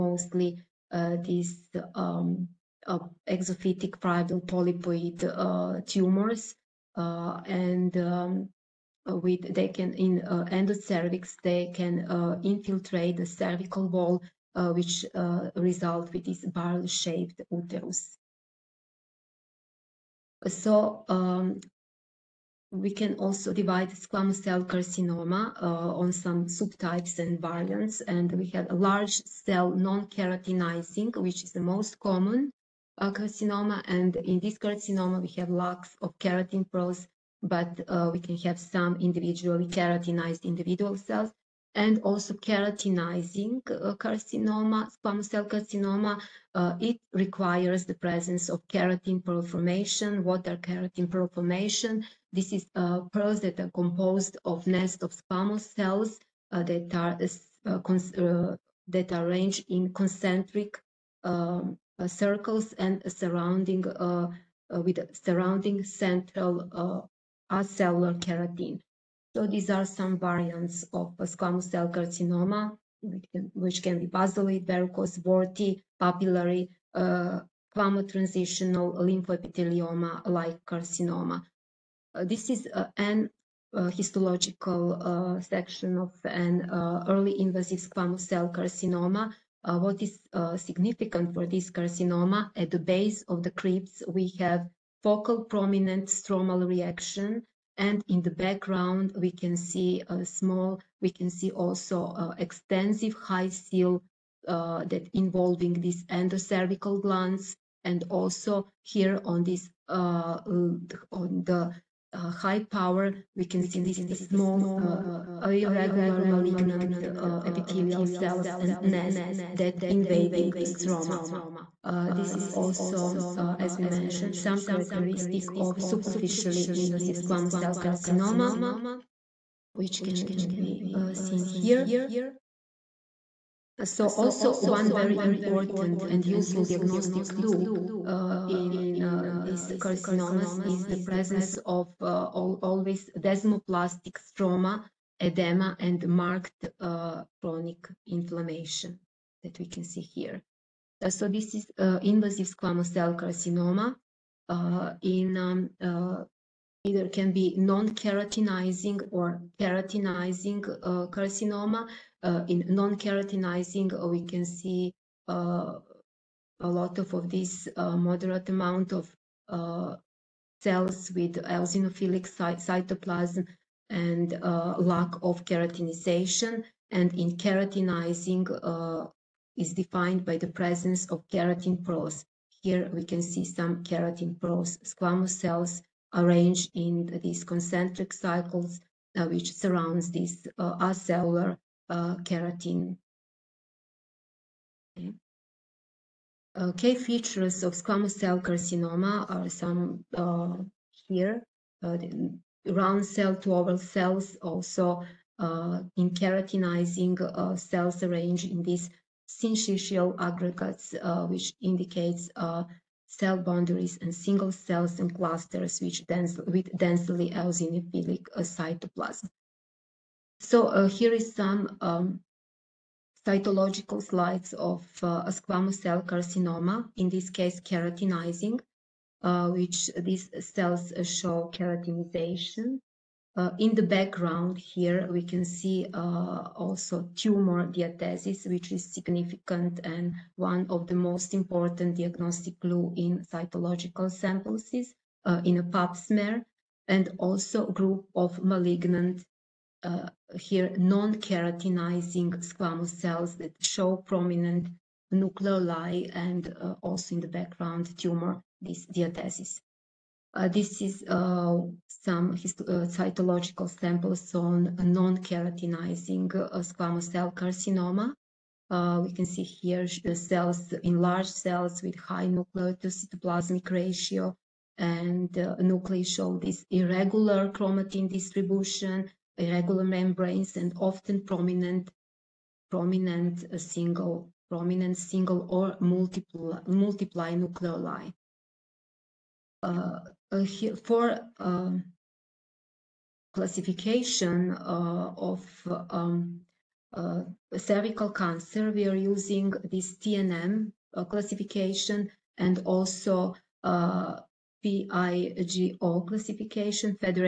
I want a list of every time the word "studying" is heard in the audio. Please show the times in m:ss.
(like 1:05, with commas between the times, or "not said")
not said.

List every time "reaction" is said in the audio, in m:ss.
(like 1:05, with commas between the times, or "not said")
1:36.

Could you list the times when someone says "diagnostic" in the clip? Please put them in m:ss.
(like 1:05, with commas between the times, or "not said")
2:16, 4:01.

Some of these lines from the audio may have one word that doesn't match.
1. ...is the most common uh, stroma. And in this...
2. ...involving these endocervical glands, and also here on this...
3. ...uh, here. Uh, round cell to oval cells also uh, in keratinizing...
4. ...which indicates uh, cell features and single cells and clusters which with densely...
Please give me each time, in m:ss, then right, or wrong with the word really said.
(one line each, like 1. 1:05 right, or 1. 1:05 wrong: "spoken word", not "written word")
1. 0:31 wrong: "carcinoma", not "stroma"
2. 1:45 right
3. 3:20 right
4. 3:31 wrong: "boundaries", not "features".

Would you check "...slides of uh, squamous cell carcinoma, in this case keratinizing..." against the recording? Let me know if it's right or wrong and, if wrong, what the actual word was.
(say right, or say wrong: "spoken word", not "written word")
right.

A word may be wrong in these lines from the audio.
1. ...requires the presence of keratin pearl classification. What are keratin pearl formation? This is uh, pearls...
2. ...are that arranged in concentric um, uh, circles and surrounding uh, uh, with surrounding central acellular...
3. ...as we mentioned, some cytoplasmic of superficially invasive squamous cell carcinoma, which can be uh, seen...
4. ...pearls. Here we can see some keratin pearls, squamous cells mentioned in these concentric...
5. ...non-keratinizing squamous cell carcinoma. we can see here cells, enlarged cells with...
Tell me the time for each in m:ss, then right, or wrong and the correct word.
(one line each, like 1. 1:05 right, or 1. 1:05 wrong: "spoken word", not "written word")
1. 0:47 wrong: "formation", not "classification"
2. 0:57 right
3. 2:03 wrong: "characteristic", not "cytoplasmic"
4. 3:01 wrong: "arranged", not "mentioned"
5. 4:24 right.